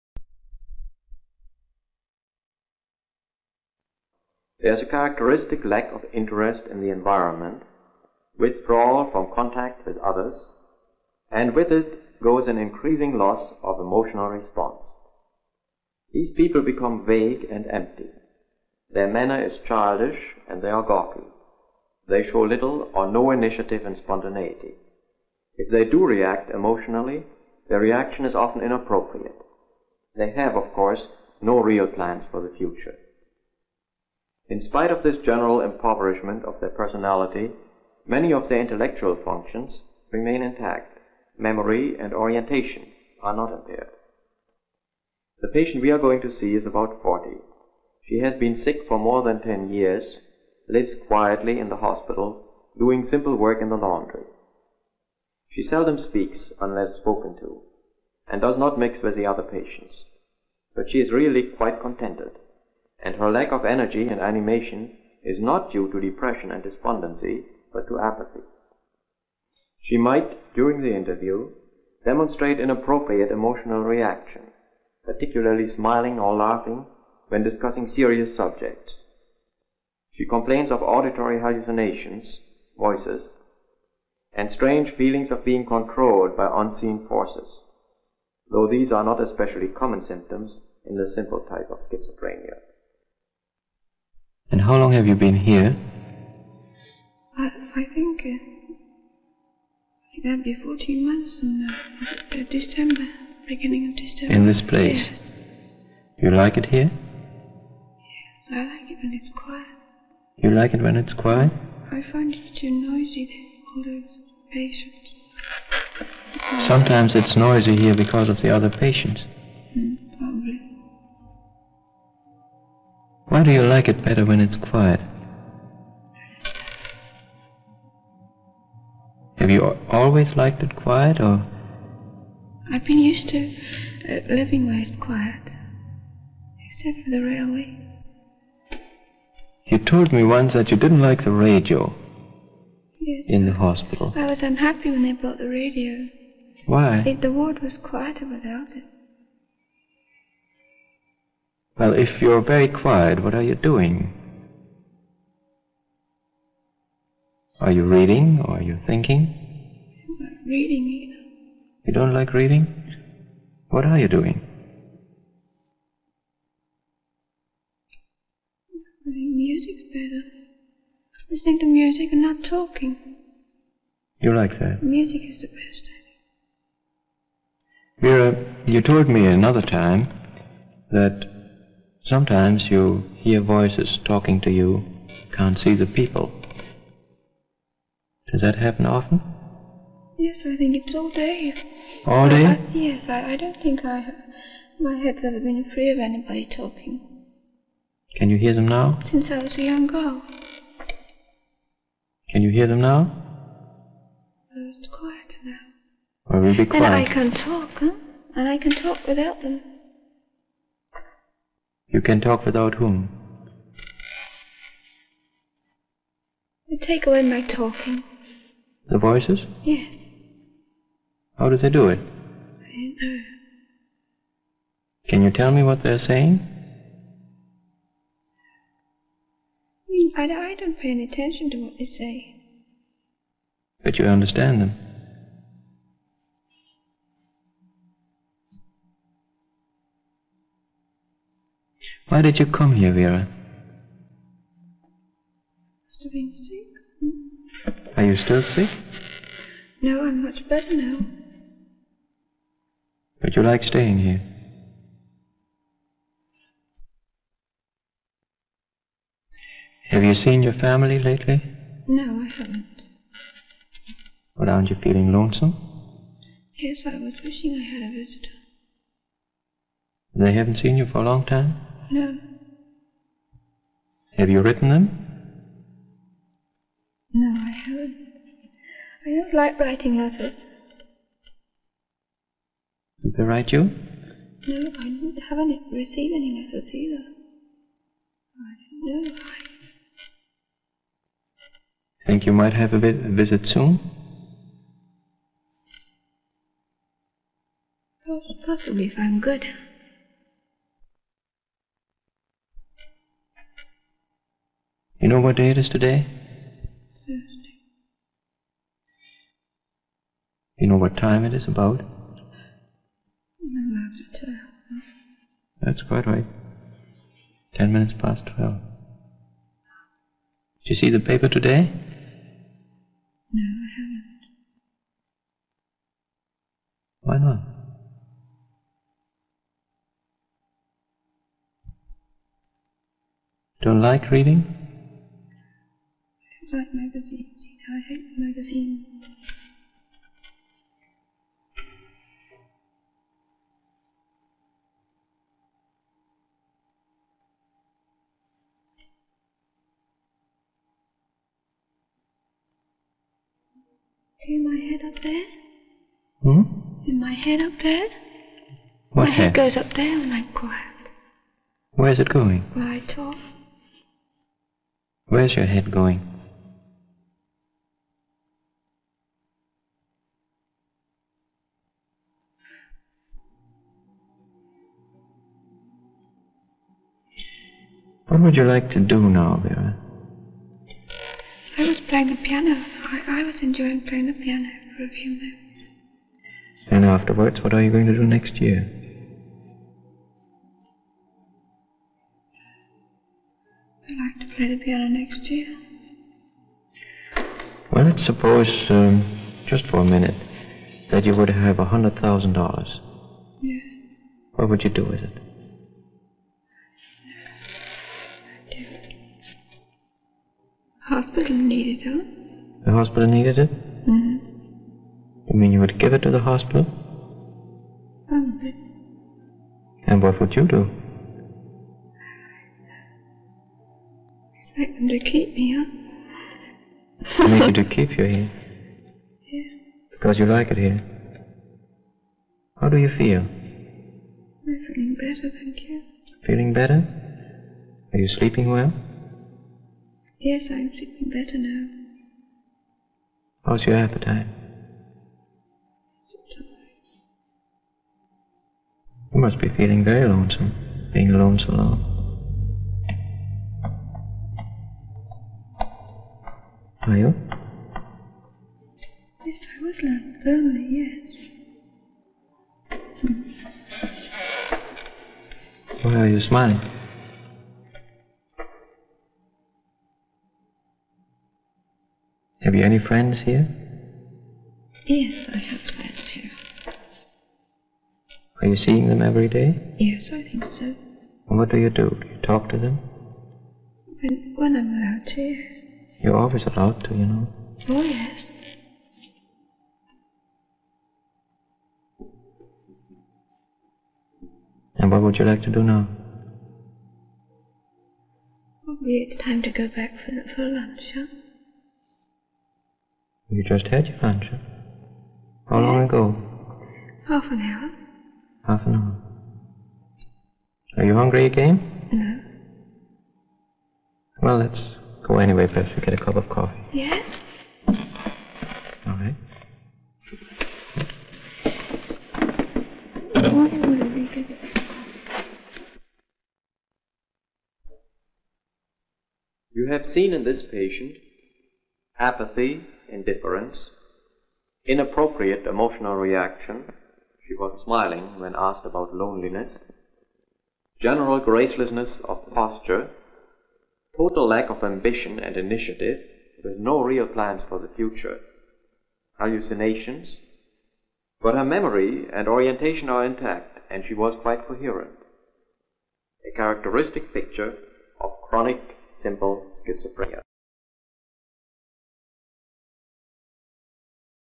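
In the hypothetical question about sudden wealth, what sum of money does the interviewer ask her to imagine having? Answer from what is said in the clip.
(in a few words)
$100,000.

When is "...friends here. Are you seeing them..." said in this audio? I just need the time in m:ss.
7:55.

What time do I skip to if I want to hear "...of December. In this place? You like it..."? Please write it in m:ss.
1:43.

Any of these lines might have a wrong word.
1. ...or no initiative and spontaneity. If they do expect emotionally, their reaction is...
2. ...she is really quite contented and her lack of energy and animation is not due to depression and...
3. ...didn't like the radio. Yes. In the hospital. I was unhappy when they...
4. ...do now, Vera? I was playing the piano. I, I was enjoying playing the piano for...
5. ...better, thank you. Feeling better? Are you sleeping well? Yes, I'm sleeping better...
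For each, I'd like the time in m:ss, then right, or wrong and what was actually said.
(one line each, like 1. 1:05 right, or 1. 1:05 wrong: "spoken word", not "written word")
1. 0:22 wrong: "react", not "expect"
2. 1:00 right
3. 2:20 right
4. 6:18 right
5. 7:14 right.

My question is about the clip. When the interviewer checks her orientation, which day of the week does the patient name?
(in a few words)
Thursday.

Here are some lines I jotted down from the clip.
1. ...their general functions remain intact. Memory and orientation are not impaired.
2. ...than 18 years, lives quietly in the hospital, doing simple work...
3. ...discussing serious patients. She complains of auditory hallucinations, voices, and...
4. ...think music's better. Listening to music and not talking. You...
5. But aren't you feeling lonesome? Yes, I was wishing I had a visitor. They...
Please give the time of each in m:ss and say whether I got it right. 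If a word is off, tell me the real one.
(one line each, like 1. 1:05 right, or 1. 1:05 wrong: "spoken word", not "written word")
1. 0:38 wrong: "intellectual", not "general"
2. 0:49 wrong: "10", not "18"
3. 1:17 wrong: "subjects", not "patients"
4. 2:49 right
5. 4:24 right.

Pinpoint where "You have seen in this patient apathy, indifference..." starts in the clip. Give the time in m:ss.
8:49.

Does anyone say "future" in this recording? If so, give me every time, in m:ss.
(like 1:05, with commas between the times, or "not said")
0:32, 9:07.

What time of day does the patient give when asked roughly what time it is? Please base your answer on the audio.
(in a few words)
12:11.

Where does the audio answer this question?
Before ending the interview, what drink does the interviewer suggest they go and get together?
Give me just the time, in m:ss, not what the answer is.
8:35.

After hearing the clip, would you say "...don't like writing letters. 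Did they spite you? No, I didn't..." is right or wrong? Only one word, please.
wrong.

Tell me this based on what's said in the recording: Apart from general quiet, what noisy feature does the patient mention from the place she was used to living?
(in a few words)
The railway.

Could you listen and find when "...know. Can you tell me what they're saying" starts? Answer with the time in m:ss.
3:43.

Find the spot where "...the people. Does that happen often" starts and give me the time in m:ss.
3:05.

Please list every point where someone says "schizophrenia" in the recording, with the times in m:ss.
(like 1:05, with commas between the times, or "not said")
1:31, 9:19.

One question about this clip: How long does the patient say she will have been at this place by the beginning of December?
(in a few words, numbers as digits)
14 months.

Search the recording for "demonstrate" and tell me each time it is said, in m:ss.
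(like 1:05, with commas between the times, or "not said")
1:12.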